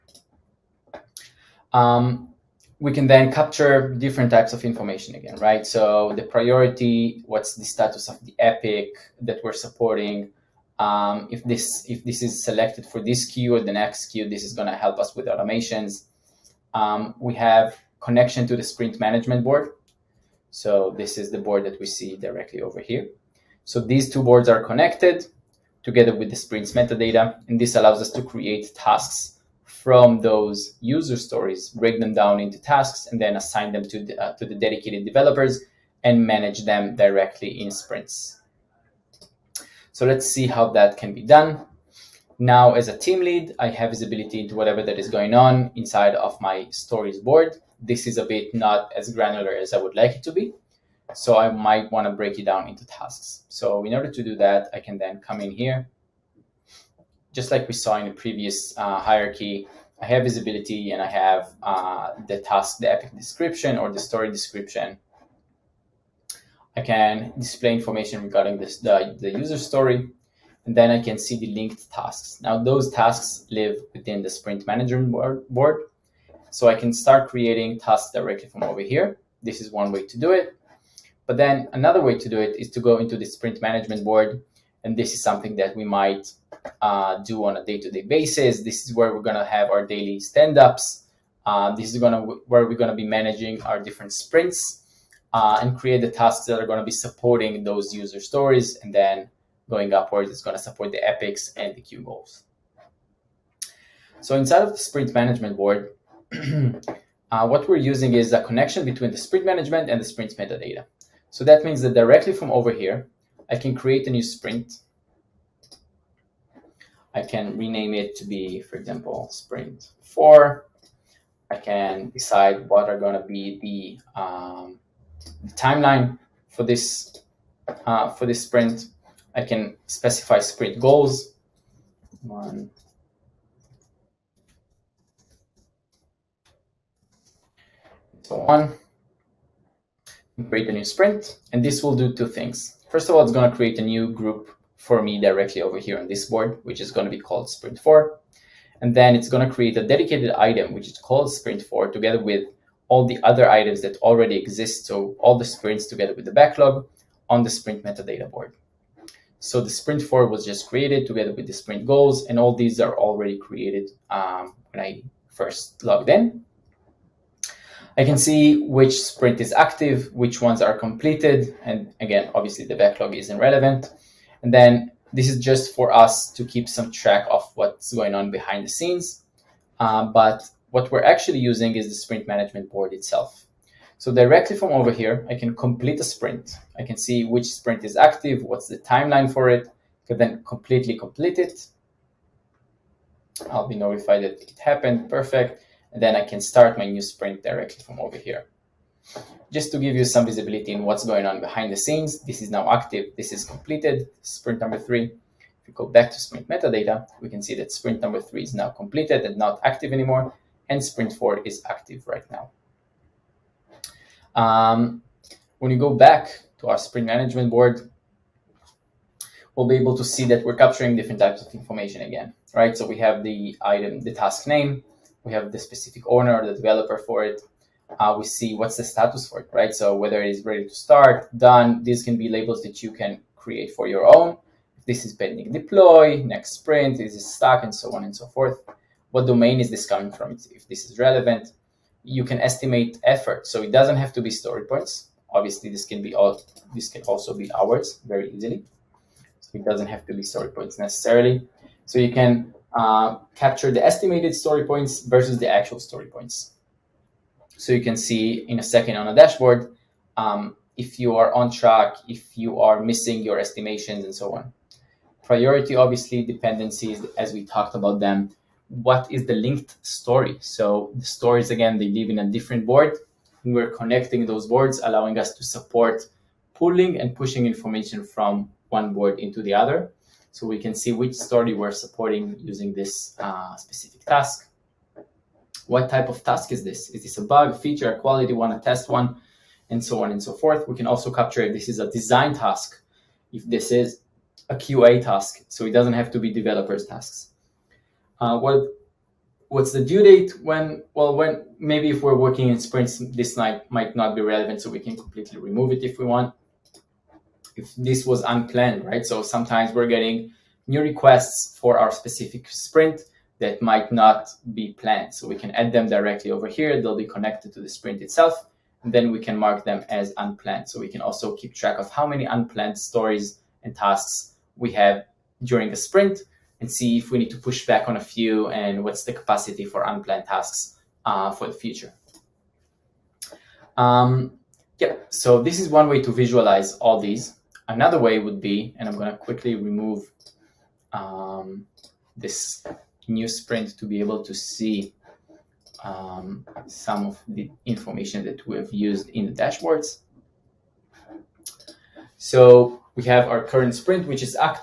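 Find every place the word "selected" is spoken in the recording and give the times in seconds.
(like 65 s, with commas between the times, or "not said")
12 s.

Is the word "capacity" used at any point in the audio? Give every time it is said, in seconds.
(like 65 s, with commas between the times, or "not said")
329 s.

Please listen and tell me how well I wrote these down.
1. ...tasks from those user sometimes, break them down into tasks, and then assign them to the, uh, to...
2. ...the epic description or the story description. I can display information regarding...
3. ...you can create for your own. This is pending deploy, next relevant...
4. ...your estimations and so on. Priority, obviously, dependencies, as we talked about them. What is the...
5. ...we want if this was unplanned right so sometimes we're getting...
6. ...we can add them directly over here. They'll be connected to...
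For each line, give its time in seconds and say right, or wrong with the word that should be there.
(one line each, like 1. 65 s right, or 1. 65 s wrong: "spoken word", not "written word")
1. 28 s wrong: "stories", not "sometimes"
2. 62 s right
3. 232 s wrong: "sprint", not "relevant"
4. 263 s right
5. 305 s right
6. 315 s right.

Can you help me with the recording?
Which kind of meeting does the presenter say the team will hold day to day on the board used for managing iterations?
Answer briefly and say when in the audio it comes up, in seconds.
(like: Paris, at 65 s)
Daily stand-ups, at 89 s.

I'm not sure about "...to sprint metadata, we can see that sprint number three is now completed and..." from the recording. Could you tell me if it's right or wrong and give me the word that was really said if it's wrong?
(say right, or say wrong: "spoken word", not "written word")
right.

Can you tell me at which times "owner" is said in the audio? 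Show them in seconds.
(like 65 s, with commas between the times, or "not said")
226 s.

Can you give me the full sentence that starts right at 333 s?
Um, yeah, so this is one way to visualize all these.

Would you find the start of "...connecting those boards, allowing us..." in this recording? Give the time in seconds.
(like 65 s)
273 s.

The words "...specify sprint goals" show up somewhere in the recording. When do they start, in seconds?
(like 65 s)
129 s.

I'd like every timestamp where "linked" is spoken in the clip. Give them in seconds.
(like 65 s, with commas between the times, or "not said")
71 s, 269 s.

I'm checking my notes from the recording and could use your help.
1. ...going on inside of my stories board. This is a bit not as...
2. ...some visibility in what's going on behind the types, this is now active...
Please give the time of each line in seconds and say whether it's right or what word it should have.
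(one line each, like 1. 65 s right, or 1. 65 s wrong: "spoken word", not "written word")
1. 45 s right
2. 200 s wrong: "scenes", not "types".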